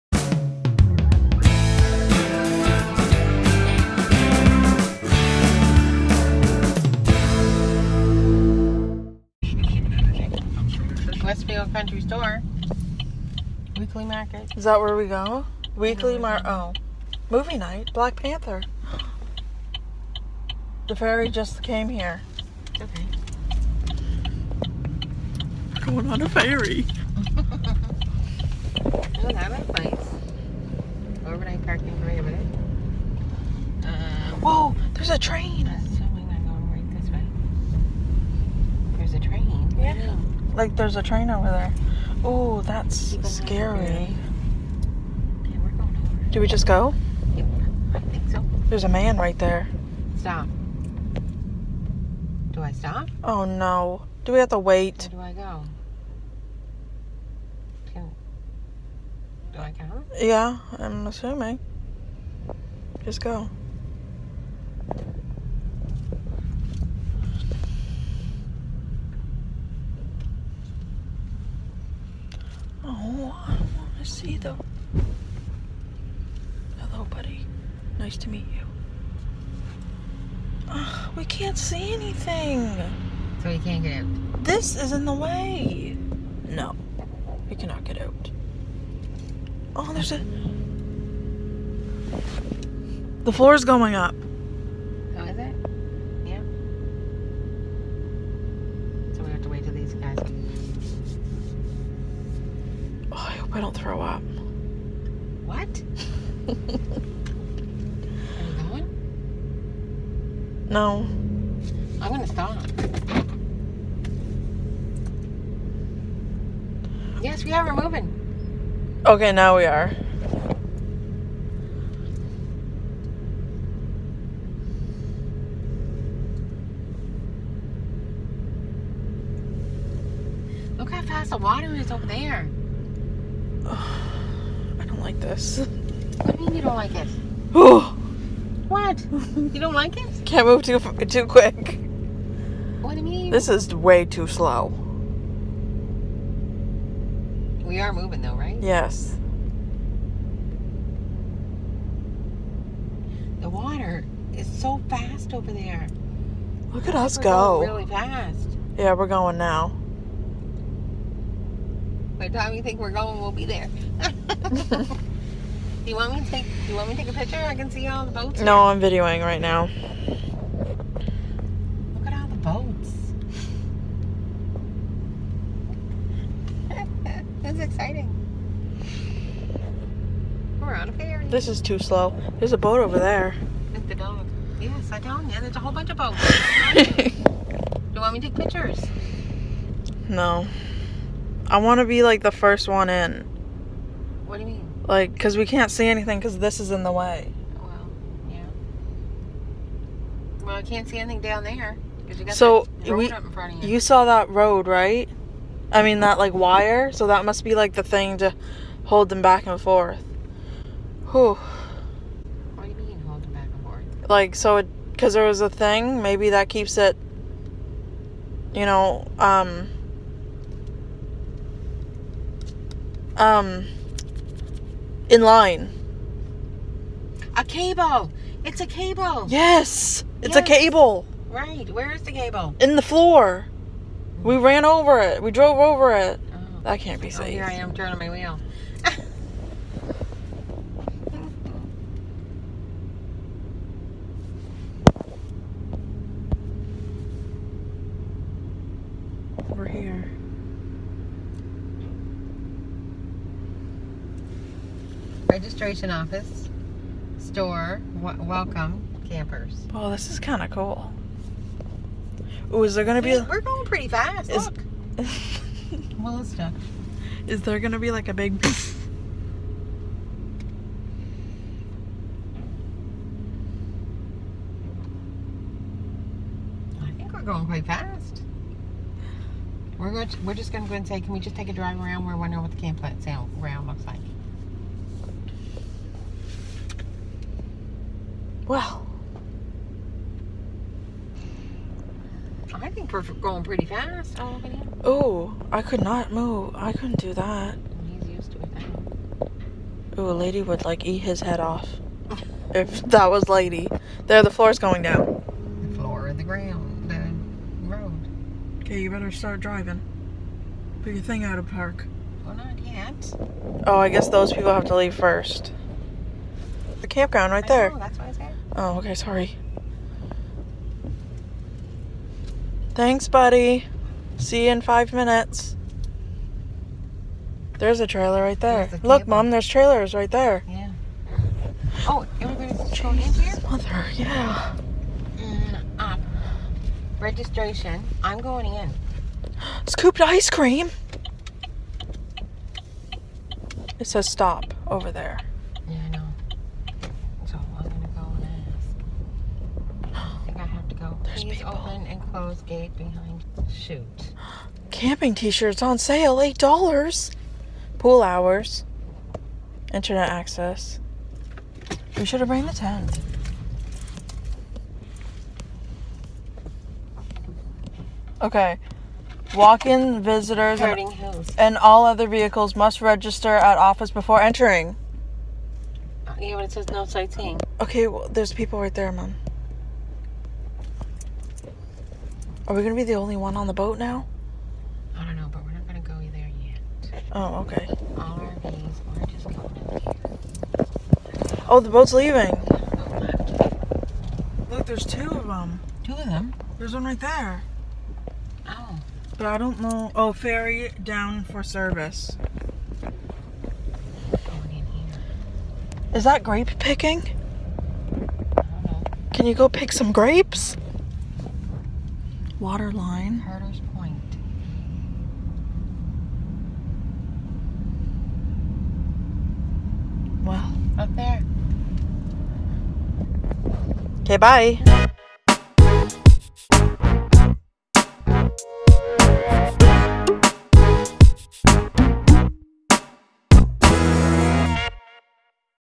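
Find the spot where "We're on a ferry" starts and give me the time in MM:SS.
03:00.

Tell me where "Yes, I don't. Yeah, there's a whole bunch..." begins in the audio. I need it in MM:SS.
03:04.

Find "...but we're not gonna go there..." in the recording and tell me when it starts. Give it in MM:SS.
06:25.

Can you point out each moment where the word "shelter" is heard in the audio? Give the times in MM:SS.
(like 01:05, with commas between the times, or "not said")
not said.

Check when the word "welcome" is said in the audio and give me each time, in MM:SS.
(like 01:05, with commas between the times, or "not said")
04:18.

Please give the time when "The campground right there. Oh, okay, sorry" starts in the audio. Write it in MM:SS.
05:16.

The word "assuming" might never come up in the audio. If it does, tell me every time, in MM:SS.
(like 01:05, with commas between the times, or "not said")
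00:35, 01:01.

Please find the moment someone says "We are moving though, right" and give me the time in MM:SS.
02:27.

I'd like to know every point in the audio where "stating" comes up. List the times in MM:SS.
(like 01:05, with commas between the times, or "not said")
not said.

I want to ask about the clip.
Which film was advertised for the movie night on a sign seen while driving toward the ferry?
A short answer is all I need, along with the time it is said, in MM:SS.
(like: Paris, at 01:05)
Black Panther, at 00:17.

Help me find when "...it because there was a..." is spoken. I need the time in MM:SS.
03:34.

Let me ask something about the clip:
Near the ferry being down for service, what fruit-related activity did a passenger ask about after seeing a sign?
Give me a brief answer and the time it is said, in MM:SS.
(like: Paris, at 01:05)
Grape picking, at 06:46.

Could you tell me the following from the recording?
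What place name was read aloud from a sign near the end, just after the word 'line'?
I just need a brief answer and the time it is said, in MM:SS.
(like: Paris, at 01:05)
Herders Point, at 06:53.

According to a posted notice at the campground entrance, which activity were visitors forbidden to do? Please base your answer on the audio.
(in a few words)
Sightseeing.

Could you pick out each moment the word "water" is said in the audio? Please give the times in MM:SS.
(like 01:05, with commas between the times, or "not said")
02:11, 02:33, 06:52.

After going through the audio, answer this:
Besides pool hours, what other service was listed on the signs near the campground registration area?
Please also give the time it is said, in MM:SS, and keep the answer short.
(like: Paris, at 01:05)
Internet access, at 05:59.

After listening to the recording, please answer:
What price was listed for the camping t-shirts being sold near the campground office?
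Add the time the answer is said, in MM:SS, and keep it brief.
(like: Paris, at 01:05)
$8, at 05:56.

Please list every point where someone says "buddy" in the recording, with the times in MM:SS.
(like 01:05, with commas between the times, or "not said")
01:17, 05:23.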